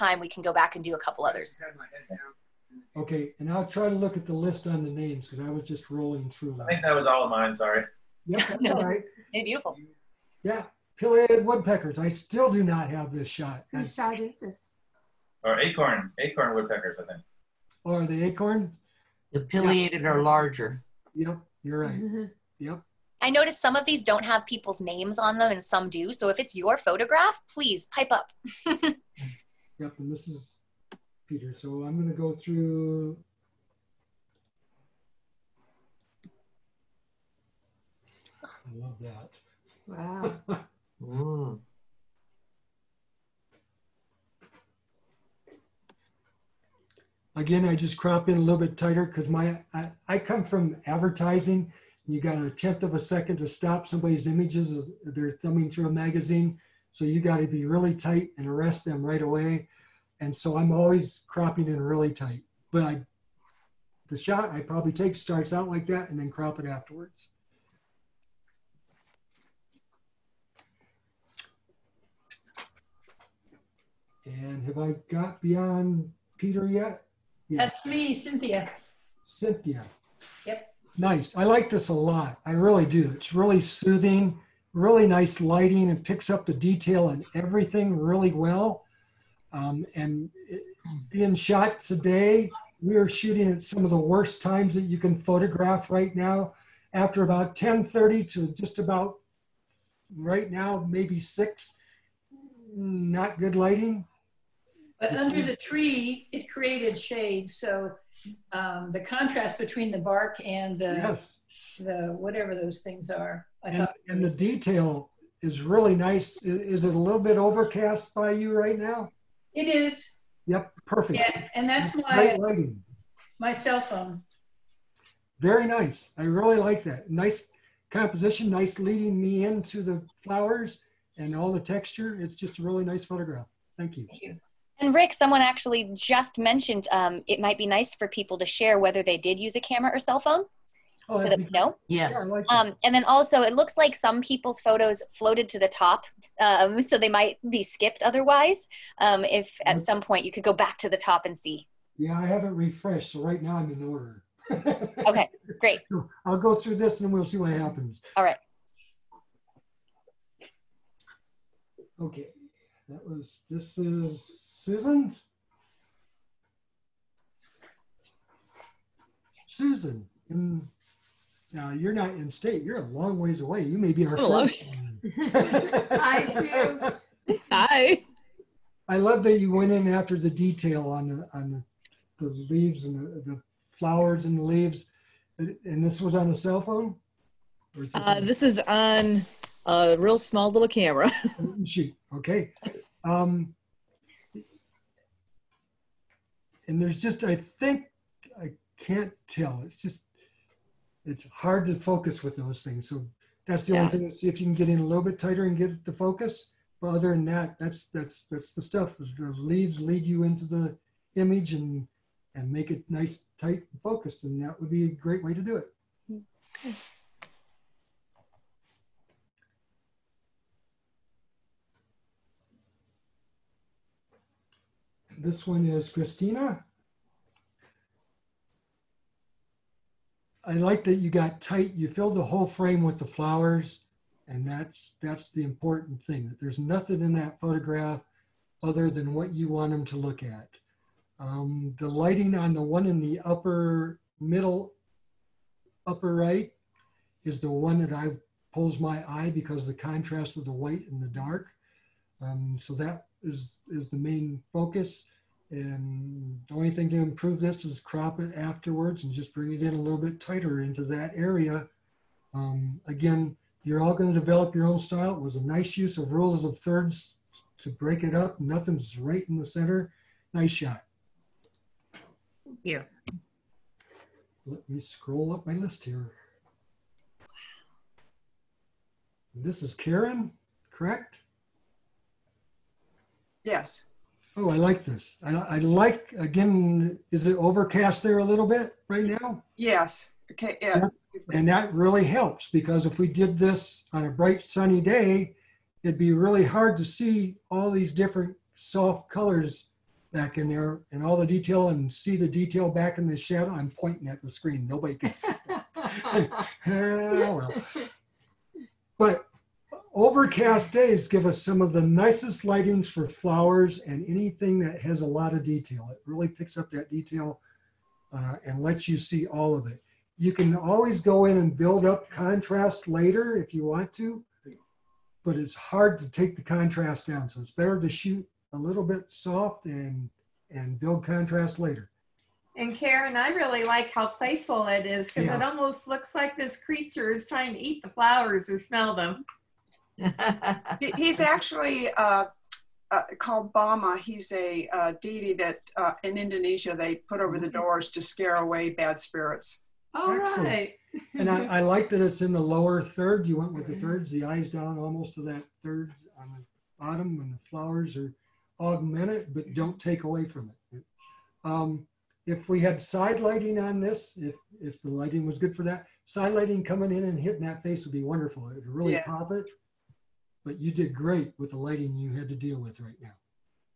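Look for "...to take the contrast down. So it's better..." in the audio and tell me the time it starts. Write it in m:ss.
5:25.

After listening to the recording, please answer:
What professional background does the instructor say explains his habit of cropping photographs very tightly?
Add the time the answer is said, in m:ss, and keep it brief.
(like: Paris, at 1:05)
advertising, at 0:50.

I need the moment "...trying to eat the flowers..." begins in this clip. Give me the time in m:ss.
5:37.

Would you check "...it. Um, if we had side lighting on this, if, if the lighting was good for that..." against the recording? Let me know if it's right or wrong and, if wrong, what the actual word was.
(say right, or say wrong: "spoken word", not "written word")
right.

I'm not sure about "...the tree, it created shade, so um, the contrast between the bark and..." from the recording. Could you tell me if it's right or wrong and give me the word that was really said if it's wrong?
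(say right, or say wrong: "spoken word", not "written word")
right.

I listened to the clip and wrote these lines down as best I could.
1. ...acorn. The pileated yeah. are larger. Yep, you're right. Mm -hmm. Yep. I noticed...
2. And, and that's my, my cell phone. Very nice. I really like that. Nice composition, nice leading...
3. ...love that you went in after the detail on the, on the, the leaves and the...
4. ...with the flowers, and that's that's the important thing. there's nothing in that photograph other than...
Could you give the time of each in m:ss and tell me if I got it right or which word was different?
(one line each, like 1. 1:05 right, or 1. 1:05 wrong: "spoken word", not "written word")
1. 0:18 right
2. 2:01 right
3. 2:58 right
4. 3:52 right.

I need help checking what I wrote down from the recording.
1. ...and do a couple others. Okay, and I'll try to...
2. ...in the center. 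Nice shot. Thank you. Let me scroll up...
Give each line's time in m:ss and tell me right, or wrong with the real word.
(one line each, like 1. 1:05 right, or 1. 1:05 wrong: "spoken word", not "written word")
1. 0:00 right
2. 4:29 right.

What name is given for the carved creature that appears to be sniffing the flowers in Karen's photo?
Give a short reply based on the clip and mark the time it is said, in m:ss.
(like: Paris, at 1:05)
Boma, at 5:43.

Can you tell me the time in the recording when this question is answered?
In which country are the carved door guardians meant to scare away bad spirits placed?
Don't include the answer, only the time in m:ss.
5:46.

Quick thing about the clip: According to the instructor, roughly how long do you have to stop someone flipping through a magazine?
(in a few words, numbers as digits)
a tenth of a second.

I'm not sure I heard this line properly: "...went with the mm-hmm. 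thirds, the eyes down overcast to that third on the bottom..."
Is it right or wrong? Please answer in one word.
wrong.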